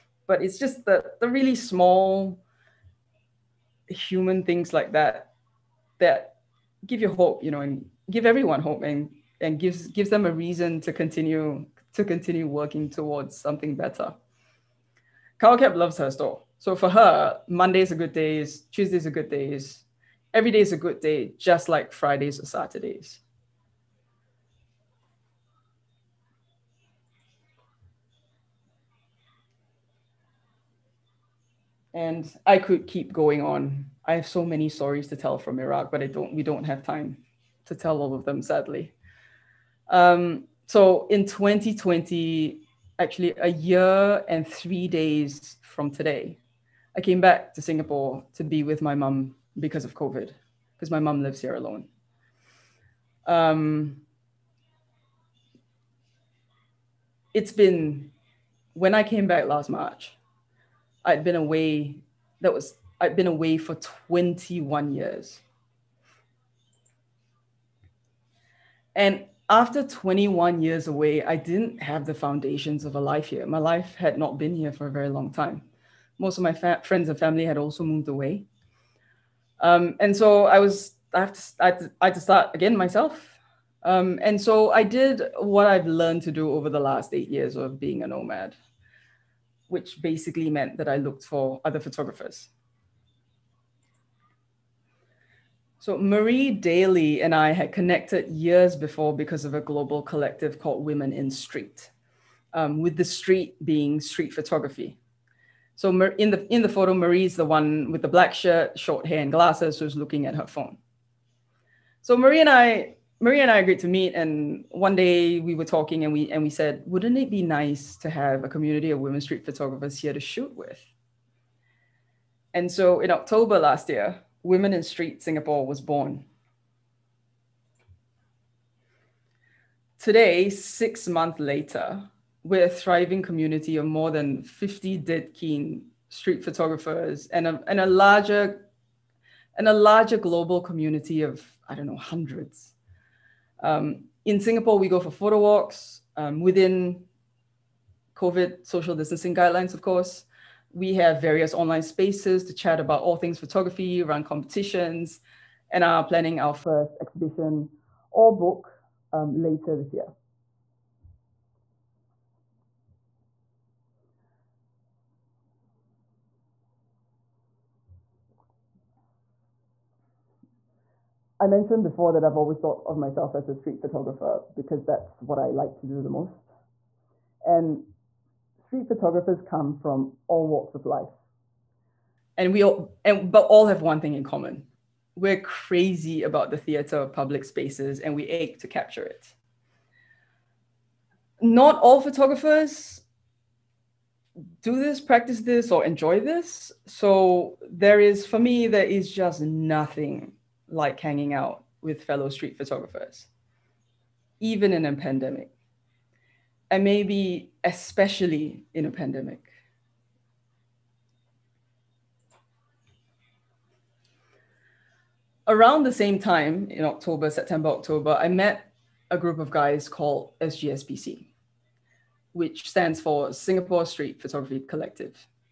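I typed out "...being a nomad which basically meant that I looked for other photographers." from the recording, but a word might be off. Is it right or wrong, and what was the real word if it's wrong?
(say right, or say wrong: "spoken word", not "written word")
right.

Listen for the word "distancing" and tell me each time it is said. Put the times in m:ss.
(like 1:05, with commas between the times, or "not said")
2:28.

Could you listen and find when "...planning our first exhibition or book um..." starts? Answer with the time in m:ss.
2:36.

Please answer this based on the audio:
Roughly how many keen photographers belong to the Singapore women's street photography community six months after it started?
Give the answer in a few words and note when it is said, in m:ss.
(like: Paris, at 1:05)
more than 50, at 2:13.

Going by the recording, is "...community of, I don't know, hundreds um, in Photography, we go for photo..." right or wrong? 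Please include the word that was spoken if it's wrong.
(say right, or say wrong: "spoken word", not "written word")
wrong: "Singapore", not "Photography".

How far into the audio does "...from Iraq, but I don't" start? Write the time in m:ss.
0:35.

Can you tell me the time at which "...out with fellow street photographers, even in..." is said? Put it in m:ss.
3:21.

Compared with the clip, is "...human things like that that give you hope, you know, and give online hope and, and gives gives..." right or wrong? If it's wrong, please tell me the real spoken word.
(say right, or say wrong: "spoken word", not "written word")
wrong: "everyone", not "online".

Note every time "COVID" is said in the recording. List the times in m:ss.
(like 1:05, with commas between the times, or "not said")
0:49, 2:28.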